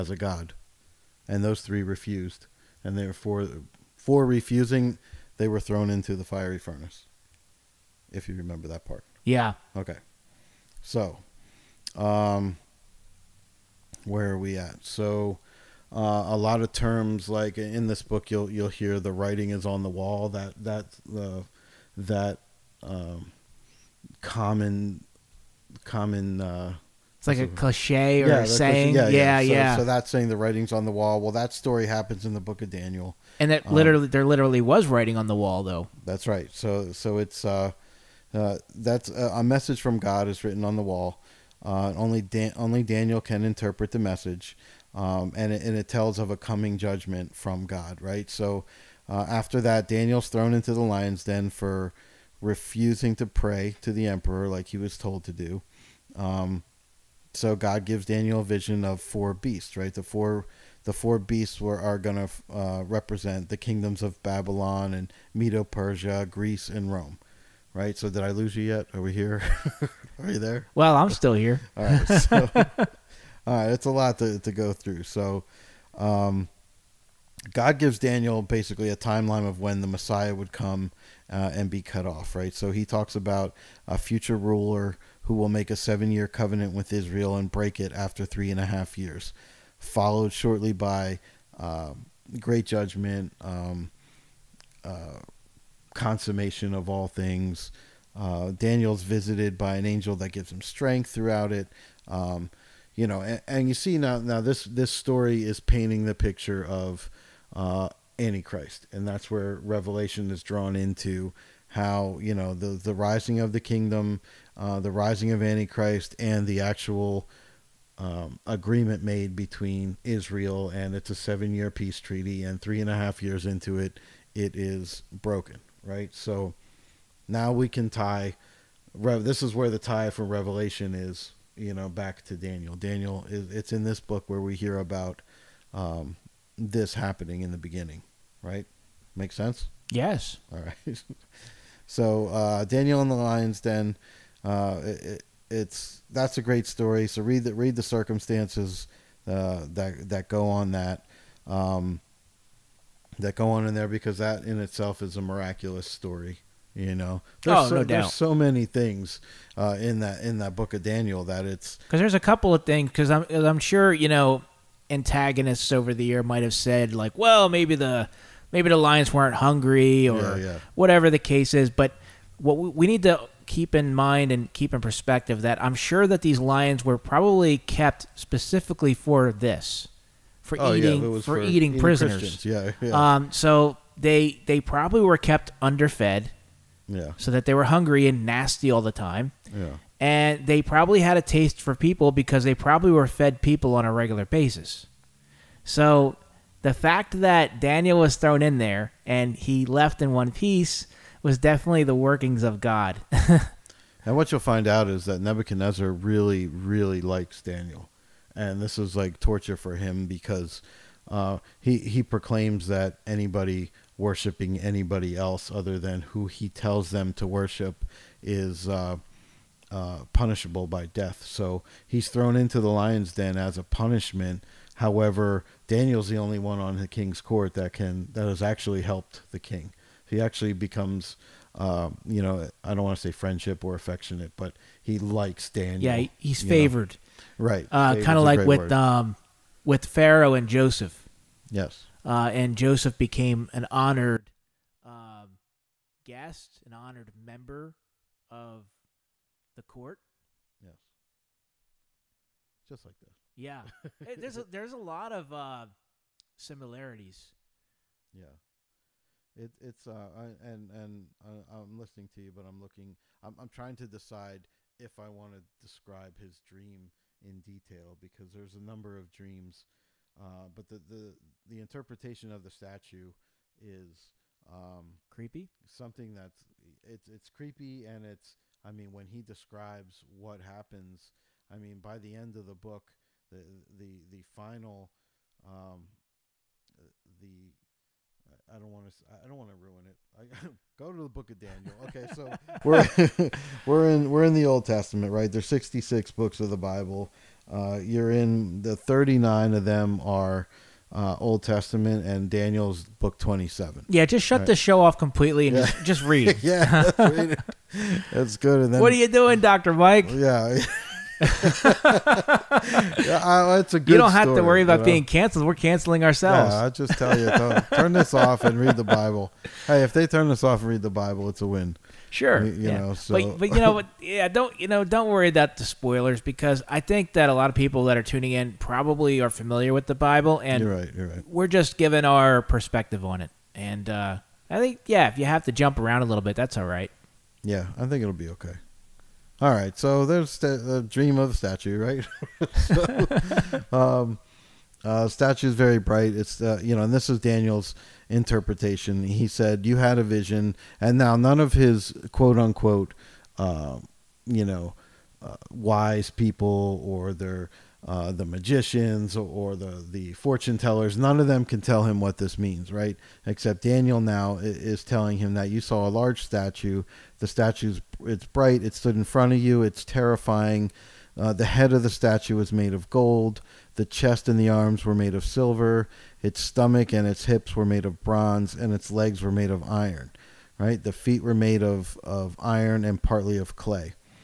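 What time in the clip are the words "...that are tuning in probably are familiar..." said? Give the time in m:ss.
5:27.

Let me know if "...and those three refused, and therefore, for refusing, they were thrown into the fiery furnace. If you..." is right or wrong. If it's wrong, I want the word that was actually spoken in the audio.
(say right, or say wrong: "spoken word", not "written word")
right.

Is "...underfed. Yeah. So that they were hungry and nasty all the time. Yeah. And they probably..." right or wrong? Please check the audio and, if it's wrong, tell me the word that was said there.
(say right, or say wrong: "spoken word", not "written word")
right.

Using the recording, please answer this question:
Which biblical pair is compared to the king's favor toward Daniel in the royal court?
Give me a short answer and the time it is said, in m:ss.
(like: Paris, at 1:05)
Pharaoh and Joseph, at 3:59.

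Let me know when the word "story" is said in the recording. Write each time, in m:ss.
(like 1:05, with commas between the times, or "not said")
0:31, 1:44, 2:26, 2:35.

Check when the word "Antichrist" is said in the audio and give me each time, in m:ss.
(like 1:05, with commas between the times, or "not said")
1:48, 1:55.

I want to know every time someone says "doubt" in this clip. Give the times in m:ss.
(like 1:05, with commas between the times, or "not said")
2:37.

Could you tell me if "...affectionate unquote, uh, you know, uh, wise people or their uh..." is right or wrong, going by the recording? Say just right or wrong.
wrong.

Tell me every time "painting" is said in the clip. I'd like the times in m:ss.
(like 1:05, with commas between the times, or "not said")
1:45.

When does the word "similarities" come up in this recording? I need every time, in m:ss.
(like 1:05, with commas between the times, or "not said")
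4:16.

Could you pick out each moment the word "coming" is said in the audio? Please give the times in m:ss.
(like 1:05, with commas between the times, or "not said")
0:46.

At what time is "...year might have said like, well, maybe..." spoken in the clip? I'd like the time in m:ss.
2:46.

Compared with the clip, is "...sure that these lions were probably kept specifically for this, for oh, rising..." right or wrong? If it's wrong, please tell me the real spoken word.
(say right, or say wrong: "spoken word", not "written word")
wrong: "eating", not "rising".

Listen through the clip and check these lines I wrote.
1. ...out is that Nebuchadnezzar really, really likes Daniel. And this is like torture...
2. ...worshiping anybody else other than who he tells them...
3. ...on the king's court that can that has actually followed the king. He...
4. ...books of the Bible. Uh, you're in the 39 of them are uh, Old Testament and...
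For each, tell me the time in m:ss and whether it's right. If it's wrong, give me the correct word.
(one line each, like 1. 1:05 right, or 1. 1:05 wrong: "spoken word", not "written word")
1. 3:24 right
2. 3:33 right
3. 3:46 wrong: "helped", not "followed"
4. 4:56 right.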